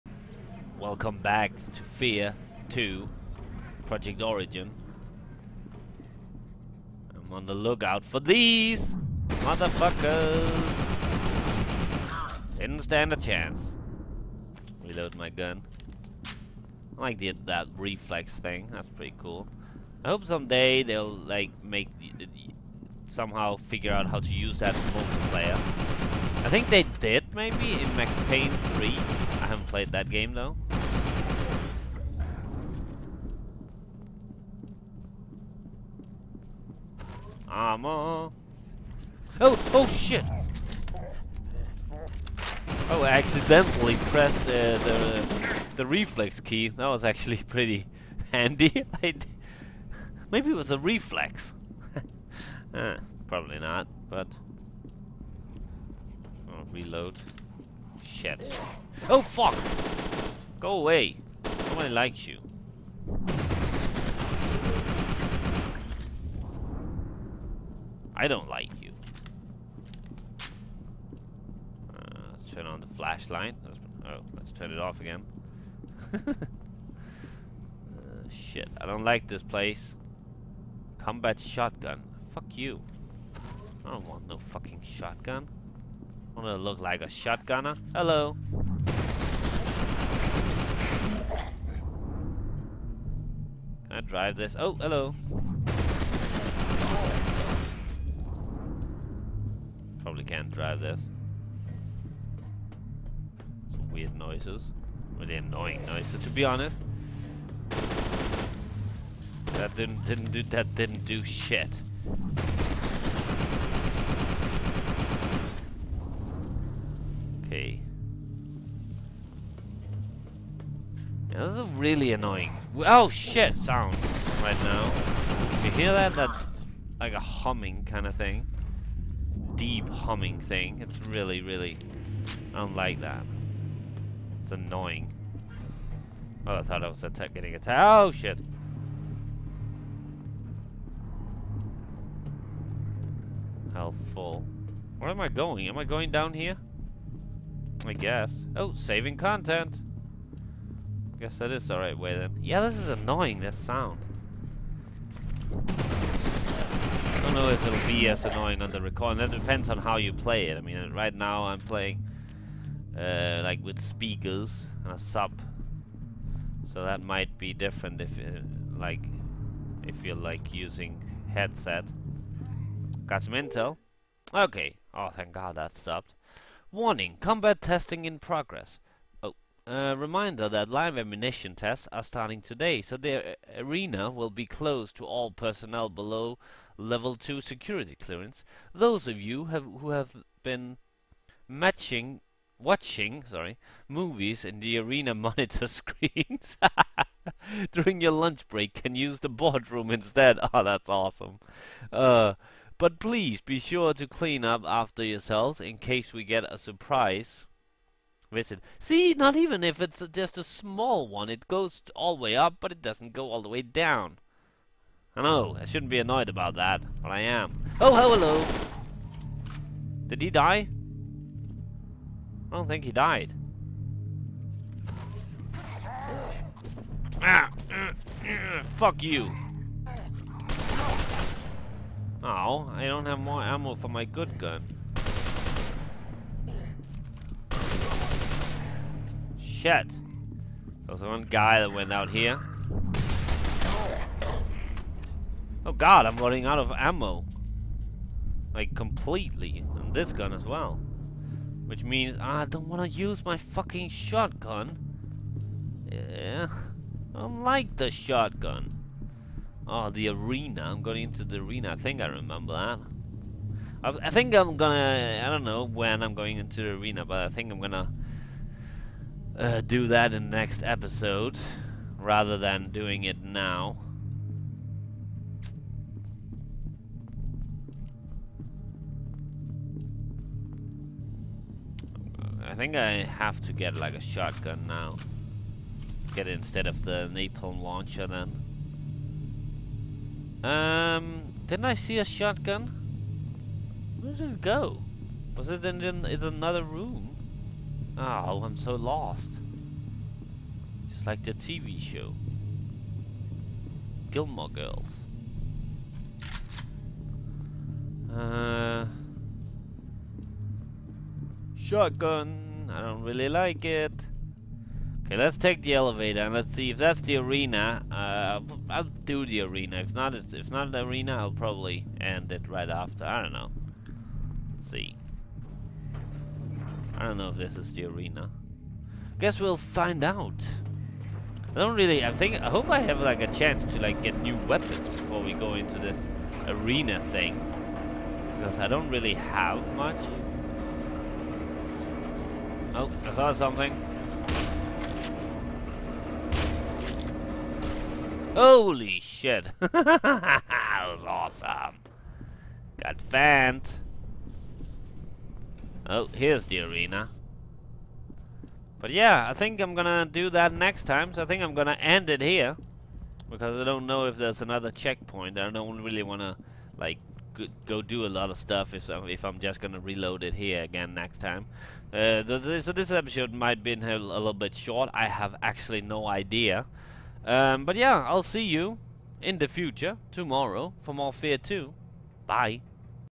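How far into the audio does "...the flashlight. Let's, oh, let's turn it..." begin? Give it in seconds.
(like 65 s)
72 s.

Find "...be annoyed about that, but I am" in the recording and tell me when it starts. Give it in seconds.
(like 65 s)
215 s.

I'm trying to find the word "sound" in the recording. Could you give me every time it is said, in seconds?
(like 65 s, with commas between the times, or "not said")
123 s, 153 s.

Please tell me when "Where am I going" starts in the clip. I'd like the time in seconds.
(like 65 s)
144 s.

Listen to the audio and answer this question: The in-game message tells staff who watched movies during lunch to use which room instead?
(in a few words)
the boardroom.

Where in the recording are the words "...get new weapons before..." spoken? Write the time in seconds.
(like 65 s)
334 s.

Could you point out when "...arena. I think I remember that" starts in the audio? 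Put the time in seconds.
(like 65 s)
261 s.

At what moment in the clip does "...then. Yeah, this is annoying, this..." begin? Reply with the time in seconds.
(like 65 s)
152 s.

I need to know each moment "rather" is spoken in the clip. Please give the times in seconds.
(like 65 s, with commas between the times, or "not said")
271 s.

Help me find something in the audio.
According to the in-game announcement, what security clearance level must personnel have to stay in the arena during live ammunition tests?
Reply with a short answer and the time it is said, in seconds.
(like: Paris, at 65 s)
level 2, at 186 s.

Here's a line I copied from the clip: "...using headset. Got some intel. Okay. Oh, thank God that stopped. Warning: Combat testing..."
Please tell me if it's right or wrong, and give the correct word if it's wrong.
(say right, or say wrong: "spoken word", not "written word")
right.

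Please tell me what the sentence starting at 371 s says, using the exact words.
Uh, so, this, so this episode might be a little bit short.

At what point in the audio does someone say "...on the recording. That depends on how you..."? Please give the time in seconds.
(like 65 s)
158 s.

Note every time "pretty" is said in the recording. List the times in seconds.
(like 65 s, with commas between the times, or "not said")
18 s, 47 s.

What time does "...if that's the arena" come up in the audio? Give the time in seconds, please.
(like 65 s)
316 s.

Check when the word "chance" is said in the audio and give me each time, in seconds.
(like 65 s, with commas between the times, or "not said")
13 s, 333 s.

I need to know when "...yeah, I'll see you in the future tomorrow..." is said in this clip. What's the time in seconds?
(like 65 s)
377 s.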